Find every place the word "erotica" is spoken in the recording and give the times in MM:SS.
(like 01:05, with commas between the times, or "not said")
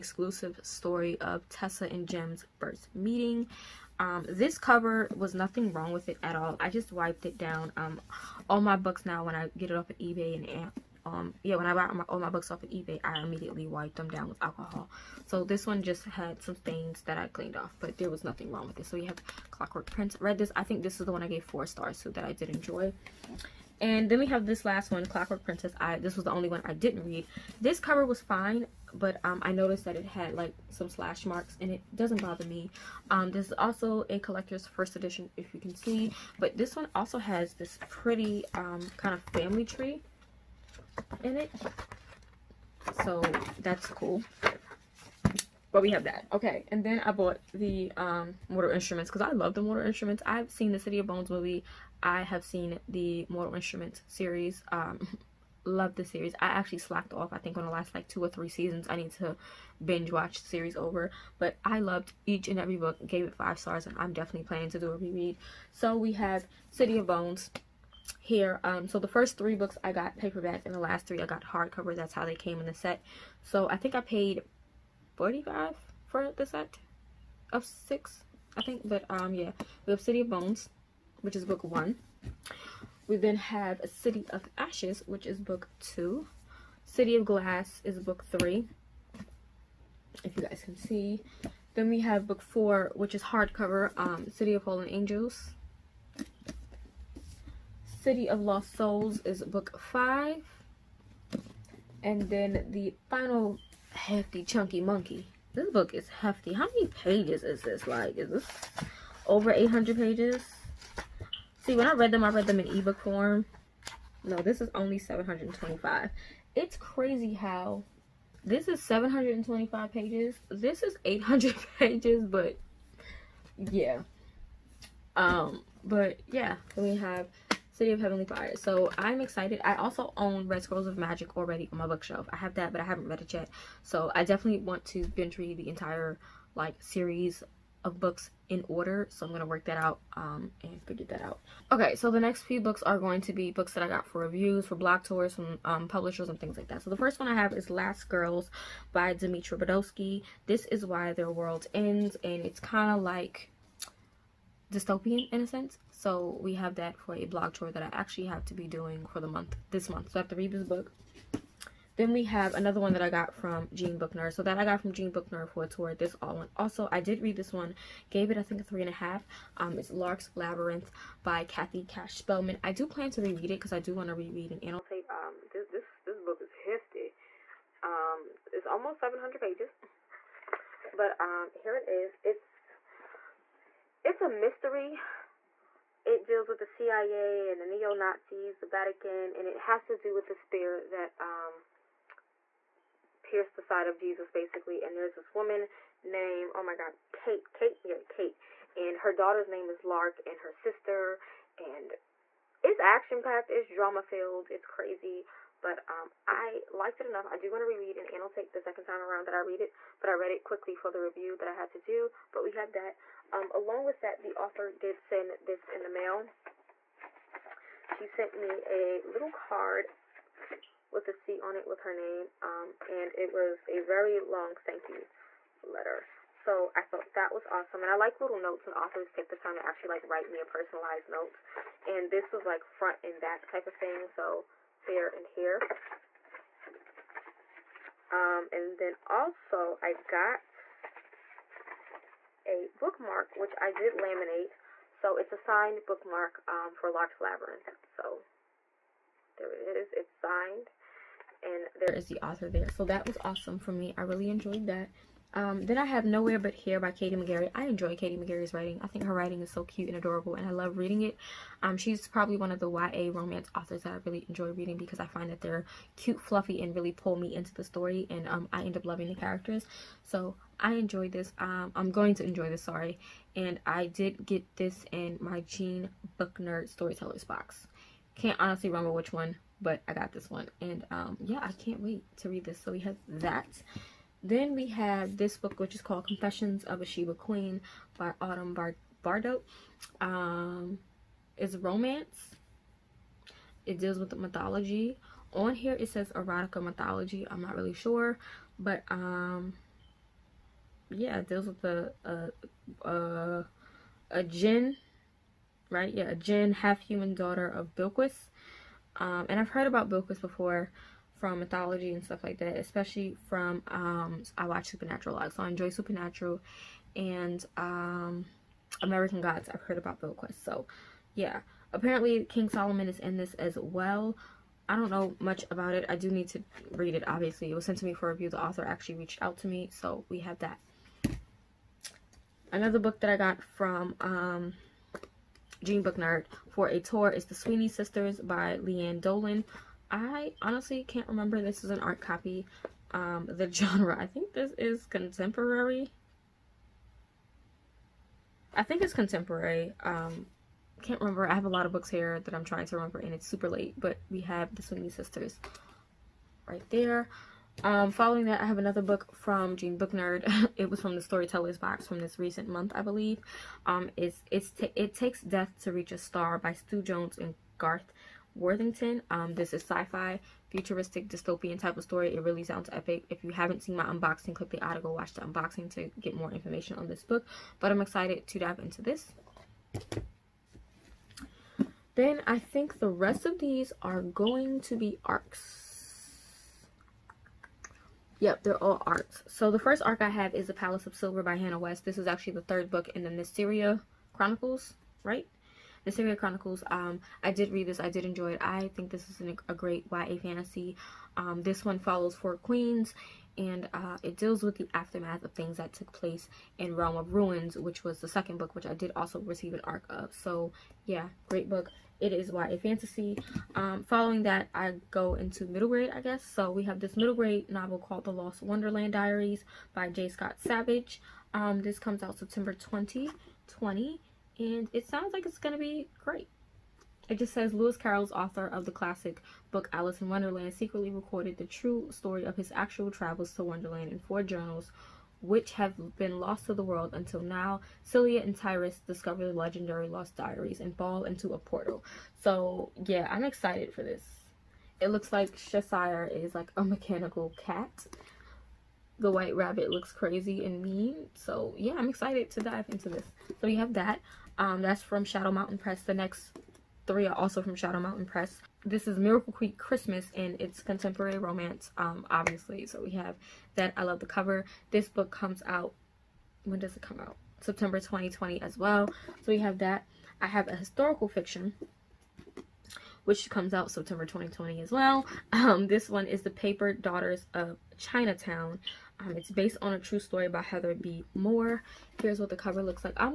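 04:56.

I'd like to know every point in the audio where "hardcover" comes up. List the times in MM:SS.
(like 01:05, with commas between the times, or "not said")
01:11, 01:33.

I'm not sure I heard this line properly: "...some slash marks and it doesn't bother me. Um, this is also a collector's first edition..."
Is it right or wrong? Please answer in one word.
right.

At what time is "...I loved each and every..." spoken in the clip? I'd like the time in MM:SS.
01:01.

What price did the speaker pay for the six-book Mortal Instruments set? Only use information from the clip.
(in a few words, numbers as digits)
45.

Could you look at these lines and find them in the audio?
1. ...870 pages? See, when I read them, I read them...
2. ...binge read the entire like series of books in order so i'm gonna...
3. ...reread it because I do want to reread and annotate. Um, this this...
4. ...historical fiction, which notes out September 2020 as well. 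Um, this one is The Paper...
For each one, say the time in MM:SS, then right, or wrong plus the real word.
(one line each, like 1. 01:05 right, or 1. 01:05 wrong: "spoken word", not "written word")
1. 01:49 wrong: "800", not "870"
2. 02:15 right
3. 02:53 right
4. 07:50 wrong: "comes", not "notes".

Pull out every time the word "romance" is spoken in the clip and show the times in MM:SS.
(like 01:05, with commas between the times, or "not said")
04:23, 04:51, 07:41.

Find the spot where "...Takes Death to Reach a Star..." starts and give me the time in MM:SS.
06:04.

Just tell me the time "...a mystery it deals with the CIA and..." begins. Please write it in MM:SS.
03:04.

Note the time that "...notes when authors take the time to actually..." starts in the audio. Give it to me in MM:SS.
03:48.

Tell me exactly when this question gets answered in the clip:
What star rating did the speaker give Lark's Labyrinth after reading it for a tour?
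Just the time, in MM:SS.
02:48.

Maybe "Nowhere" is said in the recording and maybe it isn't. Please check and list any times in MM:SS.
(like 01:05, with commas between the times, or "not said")
04:16.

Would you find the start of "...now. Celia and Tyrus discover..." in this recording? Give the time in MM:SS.
07:17.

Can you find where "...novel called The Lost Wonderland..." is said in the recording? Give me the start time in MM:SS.
06:57.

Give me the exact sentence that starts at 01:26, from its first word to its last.
City of Glass is book three, if you guys can see.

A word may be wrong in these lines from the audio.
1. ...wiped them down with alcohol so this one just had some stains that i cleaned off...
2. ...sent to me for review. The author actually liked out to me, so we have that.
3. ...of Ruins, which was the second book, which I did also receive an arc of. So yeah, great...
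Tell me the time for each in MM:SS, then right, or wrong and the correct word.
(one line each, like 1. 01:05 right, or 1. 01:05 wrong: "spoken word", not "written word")
1. 00:13 right
2. 05:27 wrong: "reached", not "liked"
3. 06:46 right.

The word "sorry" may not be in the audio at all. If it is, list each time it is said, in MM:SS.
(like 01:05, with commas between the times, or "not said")
04:32.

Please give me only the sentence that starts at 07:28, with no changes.
The white rabbit looks crazy and mean.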